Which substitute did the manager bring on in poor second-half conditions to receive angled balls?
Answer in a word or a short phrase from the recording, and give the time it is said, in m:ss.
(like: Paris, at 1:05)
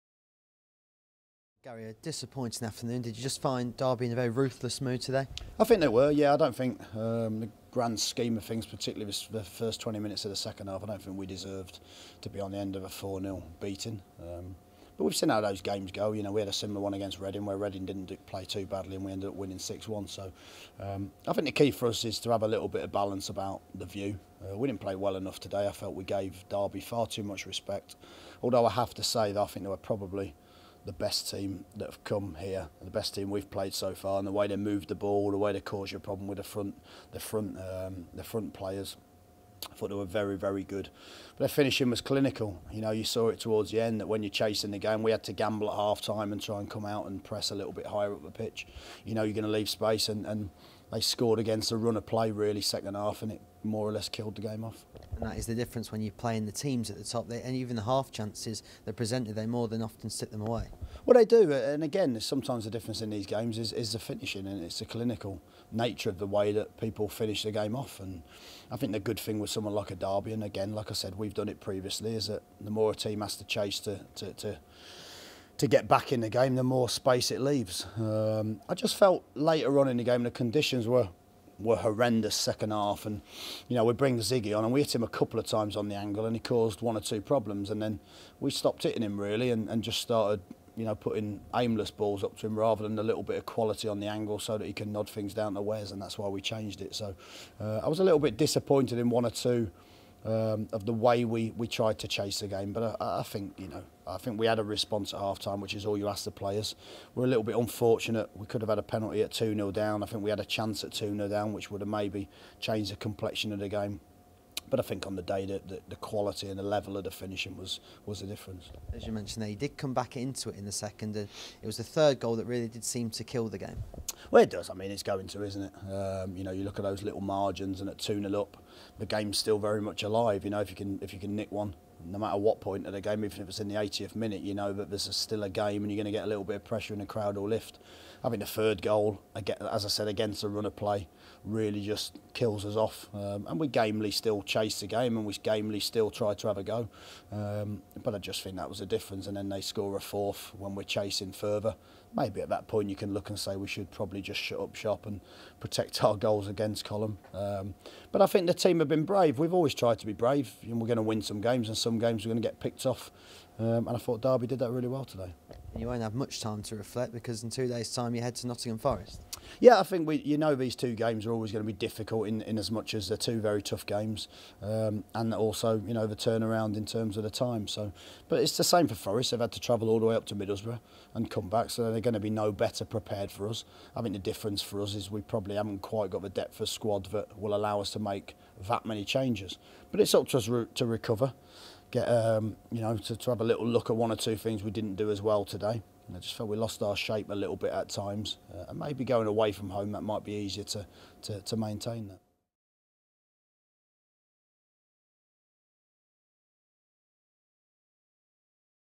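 Ziggy, at 1:24.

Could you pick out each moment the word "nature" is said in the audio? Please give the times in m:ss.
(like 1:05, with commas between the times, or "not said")
1:05.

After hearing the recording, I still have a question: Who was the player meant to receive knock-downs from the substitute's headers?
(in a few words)
Wes.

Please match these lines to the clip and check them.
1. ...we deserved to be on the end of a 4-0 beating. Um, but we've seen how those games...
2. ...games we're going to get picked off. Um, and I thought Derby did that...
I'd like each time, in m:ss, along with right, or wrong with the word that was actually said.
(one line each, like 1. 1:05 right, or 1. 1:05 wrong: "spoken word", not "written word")
1. 0:11 right
2. 2:41 right.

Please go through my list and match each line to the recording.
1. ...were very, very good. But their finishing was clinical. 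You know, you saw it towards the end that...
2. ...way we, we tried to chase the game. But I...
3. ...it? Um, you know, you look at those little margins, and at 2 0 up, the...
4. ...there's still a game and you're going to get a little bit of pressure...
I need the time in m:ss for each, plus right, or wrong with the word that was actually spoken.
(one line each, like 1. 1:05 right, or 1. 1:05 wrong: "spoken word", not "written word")
1. 0:39 right
2. 1:40 right
3. 2:05 right
4. 2:14 right.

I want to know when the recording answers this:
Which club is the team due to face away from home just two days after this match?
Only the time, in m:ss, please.
2:48.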